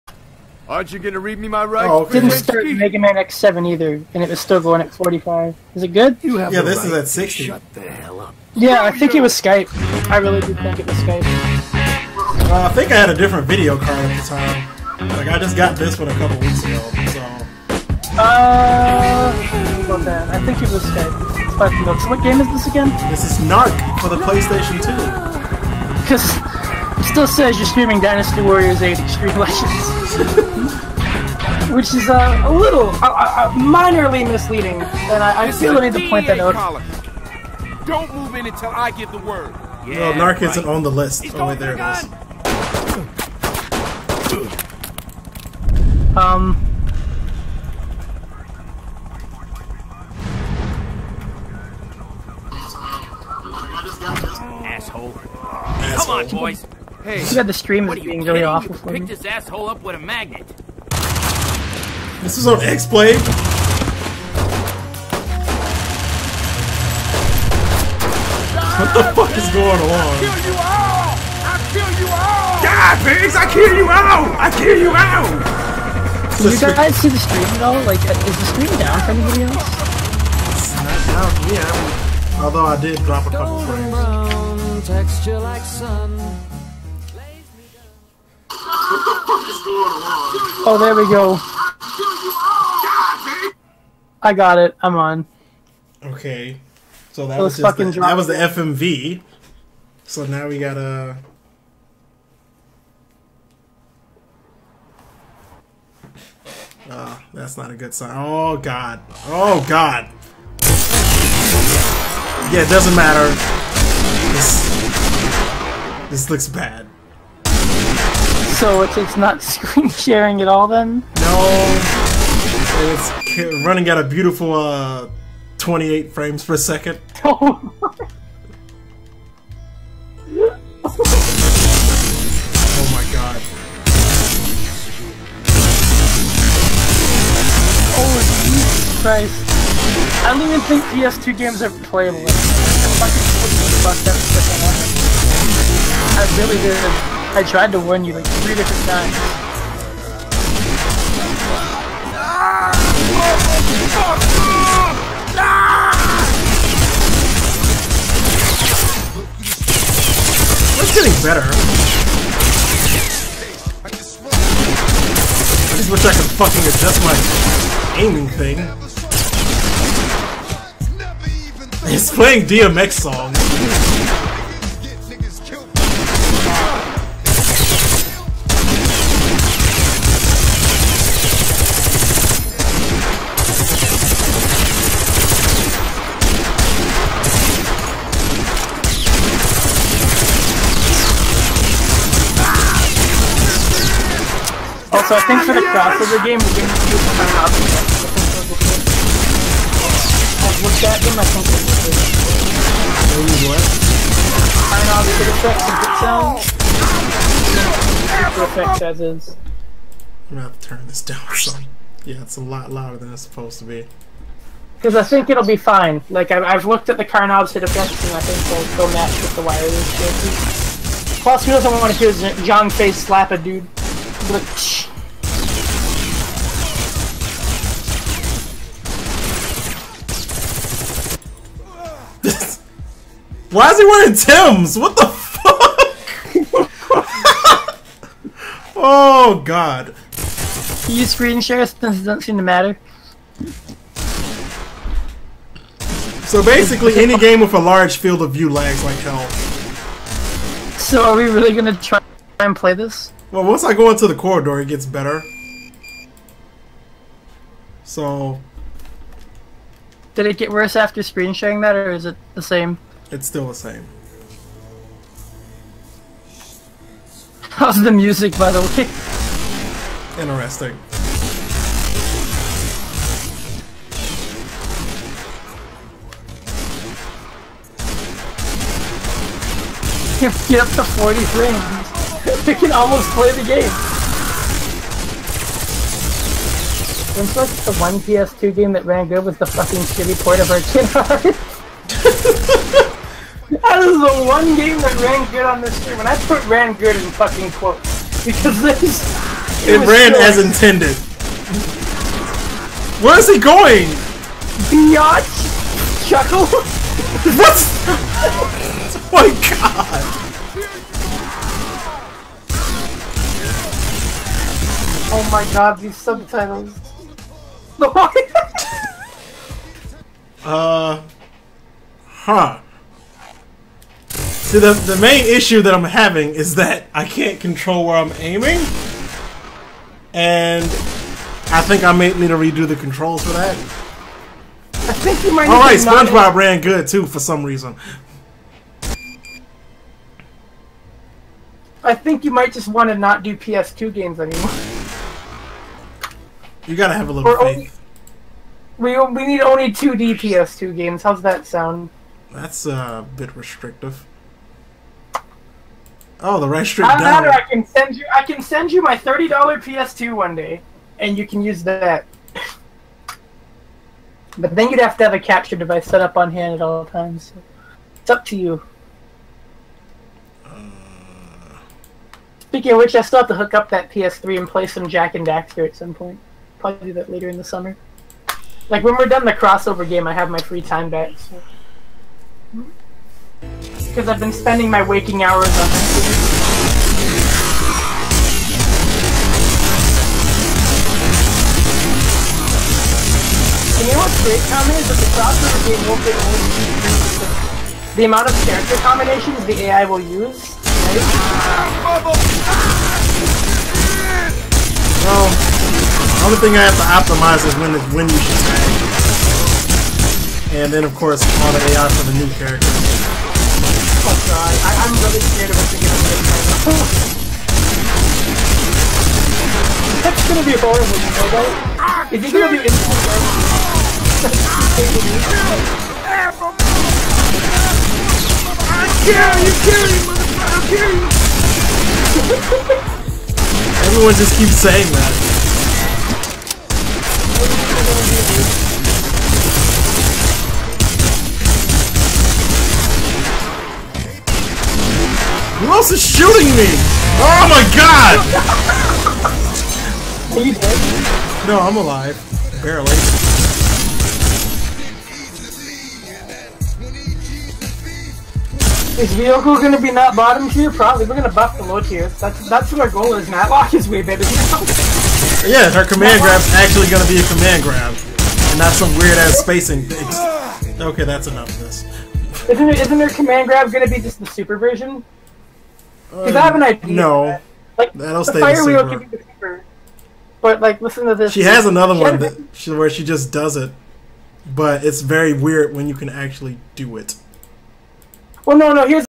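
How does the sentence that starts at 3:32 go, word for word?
Yeah, it's a lot louder than it's supposed to be.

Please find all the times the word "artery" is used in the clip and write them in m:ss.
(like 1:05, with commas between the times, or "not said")
not said.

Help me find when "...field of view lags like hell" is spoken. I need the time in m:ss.
4:07.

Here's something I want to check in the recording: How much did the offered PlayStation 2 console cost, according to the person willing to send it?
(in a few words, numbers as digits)
$30.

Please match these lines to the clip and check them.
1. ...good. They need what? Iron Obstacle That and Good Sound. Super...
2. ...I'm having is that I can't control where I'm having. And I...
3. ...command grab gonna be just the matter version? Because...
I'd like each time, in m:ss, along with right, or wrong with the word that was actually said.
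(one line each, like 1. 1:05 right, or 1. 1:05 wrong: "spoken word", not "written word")
1. 3:21 wrong: "Effects", not "That"
2. 5:25 wrong: "aiming", not "having"
3. 7:53 wrong: "super", not "matter".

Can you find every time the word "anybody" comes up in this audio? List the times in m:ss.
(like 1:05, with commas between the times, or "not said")
1:19.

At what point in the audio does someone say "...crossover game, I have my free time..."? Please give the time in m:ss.
6:19.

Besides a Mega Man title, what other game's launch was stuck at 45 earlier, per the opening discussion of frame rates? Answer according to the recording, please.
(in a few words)
Mega Man X7.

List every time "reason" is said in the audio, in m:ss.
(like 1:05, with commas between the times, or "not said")
5:37.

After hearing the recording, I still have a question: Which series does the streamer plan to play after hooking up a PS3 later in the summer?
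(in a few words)
Jak and Daxter.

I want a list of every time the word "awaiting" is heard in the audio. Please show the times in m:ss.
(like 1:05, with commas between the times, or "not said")
not said.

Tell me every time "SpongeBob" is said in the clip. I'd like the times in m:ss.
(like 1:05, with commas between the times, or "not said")
5:35.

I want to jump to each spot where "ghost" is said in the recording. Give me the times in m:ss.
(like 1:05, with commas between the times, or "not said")
not said.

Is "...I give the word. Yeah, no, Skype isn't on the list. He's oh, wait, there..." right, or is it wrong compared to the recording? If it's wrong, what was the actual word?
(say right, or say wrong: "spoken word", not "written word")
wrong: "Narc", not "Skype".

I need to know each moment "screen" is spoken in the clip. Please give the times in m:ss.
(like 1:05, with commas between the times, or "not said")
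1:59, 4:01, 4:21.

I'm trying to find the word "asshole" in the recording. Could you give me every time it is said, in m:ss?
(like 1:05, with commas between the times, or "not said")
0:54, 0:59.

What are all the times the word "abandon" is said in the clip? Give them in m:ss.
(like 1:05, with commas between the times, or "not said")
not said.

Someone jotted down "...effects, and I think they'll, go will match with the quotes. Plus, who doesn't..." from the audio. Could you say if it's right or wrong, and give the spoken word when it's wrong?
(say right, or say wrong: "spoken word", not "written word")
wrong: "wires", not "quotes".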